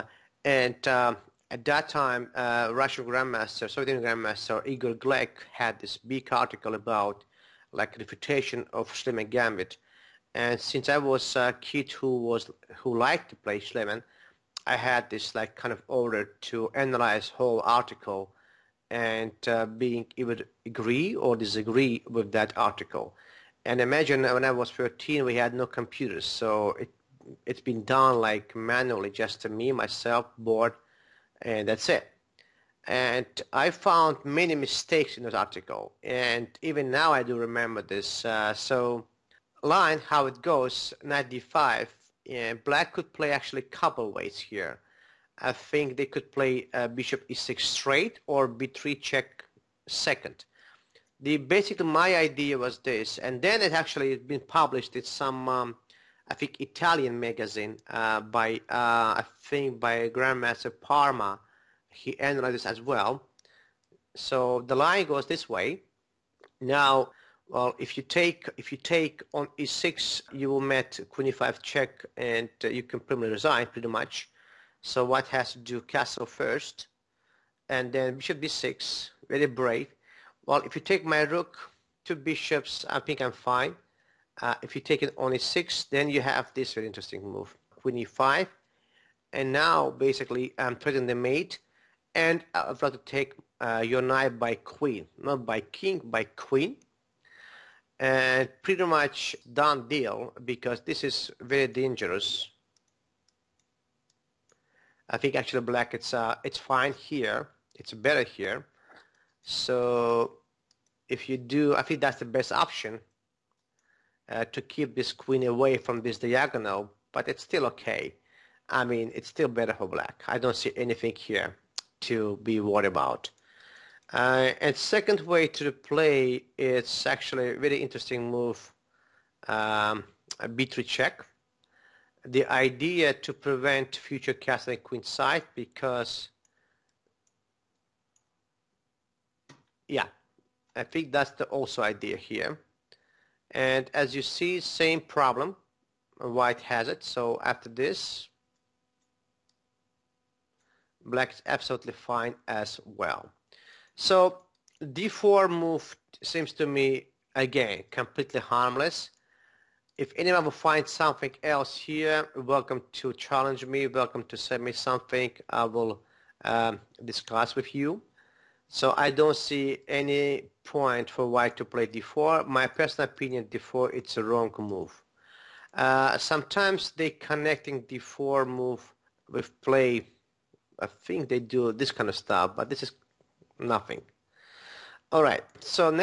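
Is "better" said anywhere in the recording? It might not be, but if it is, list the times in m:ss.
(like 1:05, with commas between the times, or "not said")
1:47, 1:59.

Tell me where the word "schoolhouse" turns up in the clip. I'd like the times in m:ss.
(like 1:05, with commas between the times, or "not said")
not said.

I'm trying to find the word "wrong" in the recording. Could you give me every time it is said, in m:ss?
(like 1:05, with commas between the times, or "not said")
2:54.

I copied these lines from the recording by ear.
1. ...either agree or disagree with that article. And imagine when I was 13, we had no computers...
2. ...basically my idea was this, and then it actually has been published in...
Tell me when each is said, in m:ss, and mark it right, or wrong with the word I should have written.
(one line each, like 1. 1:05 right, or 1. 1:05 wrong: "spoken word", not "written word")
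1. 0:20 right
2. 0:51 right.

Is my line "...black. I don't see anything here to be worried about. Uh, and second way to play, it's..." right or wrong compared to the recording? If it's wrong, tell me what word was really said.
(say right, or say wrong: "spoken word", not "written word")
right.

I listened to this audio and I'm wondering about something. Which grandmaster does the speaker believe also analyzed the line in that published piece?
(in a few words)
Parma.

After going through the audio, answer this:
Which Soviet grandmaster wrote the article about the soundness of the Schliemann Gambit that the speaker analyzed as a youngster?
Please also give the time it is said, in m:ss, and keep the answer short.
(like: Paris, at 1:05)
Igor Glek, at 0:04.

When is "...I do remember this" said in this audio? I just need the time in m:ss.
0:37.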